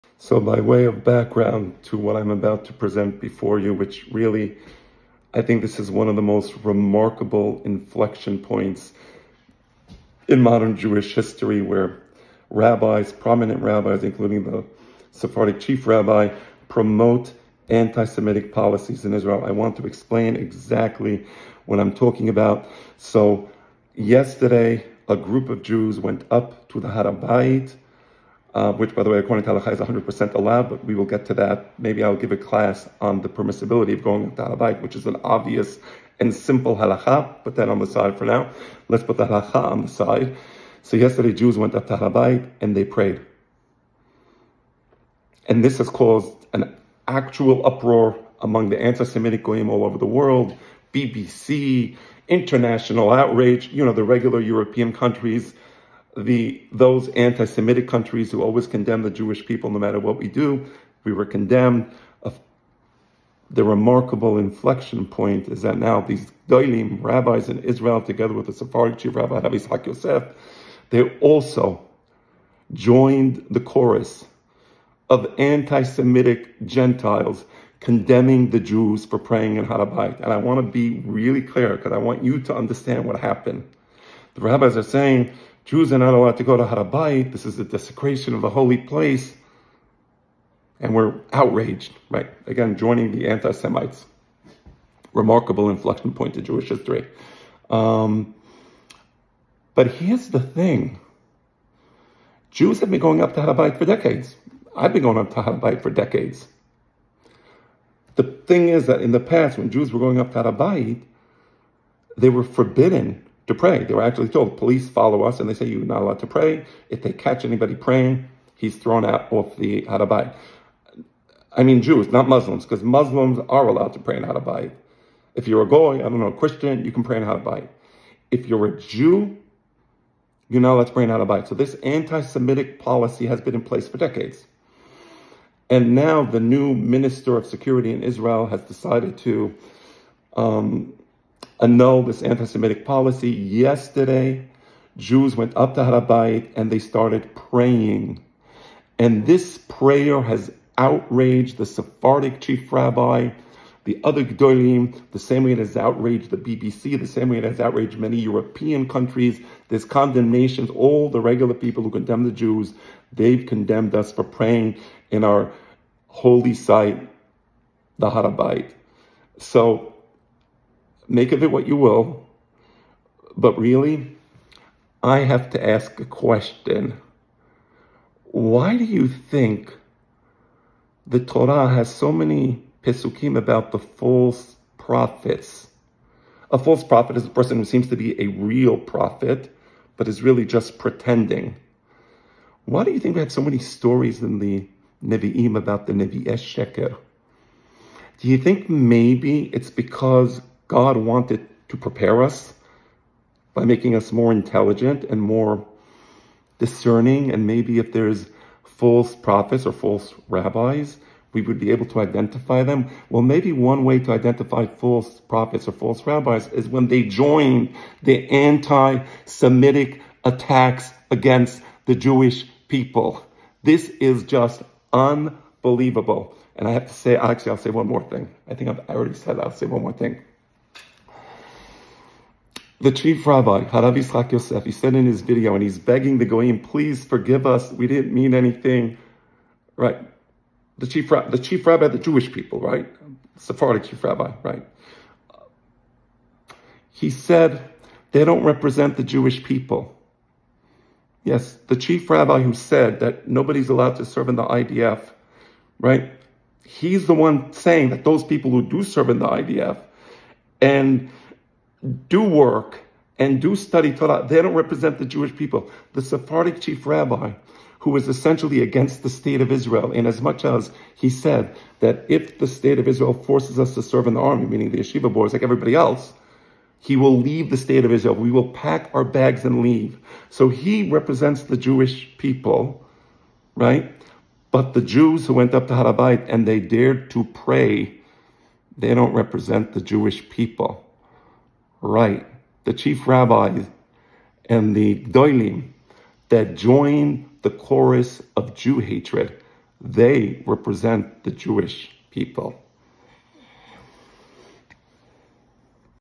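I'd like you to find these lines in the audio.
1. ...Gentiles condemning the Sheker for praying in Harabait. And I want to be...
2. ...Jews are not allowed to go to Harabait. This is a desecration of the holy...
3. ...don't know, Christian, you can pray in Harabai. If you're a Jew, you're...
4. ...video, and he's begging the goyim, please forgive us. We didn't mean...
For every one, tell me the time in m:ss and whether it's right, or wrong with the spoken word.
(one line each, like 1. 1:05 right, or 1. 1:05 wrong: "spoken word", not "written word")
1. 1:16 wrong: "Jews", not "Sheker"
2. 1:25 right
3. 2:06 right
4. 3:55 right.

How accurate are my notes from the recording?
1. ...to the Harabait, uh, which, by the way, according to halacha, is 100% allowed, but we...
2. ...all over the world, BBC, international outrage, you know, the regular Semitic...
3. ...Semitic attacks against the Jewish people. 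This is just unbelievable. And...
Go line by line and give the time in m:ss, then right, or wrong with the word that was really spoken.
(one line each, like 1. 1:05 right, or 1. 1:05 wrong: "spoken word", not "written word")
1. 0:26 right
2. 0:49 wrong: "European", not "Semitic"
3. 3:39 right.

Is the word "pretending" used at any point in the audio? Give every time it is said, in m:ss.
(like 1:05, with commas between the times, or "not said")
3:10.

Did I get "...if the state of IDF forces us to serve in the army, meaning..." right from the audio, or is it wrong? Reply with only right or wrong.
wrong.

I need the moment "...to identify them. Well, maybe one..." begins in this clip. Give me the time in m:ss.
3:31.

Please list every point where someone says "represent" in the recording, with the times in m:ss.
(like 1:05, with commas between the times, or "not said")
4:08, 4:24, 4:40, 4:49, 5:00.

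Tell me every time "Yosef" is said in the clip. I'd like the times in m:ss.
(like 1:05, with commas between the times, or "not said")
1:09, 3:54.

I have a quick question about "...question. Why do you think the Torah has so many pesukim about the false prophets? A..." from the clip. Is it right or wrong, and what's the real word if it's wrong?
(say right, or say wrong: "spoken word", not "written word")
right.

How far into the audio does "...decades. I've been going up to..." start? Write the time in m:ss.
1:43.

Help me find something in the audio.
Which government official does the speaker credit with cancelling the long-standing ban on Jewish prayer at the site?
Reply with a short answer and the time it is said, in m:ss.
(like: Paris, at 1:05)
minister of security, at 2:16.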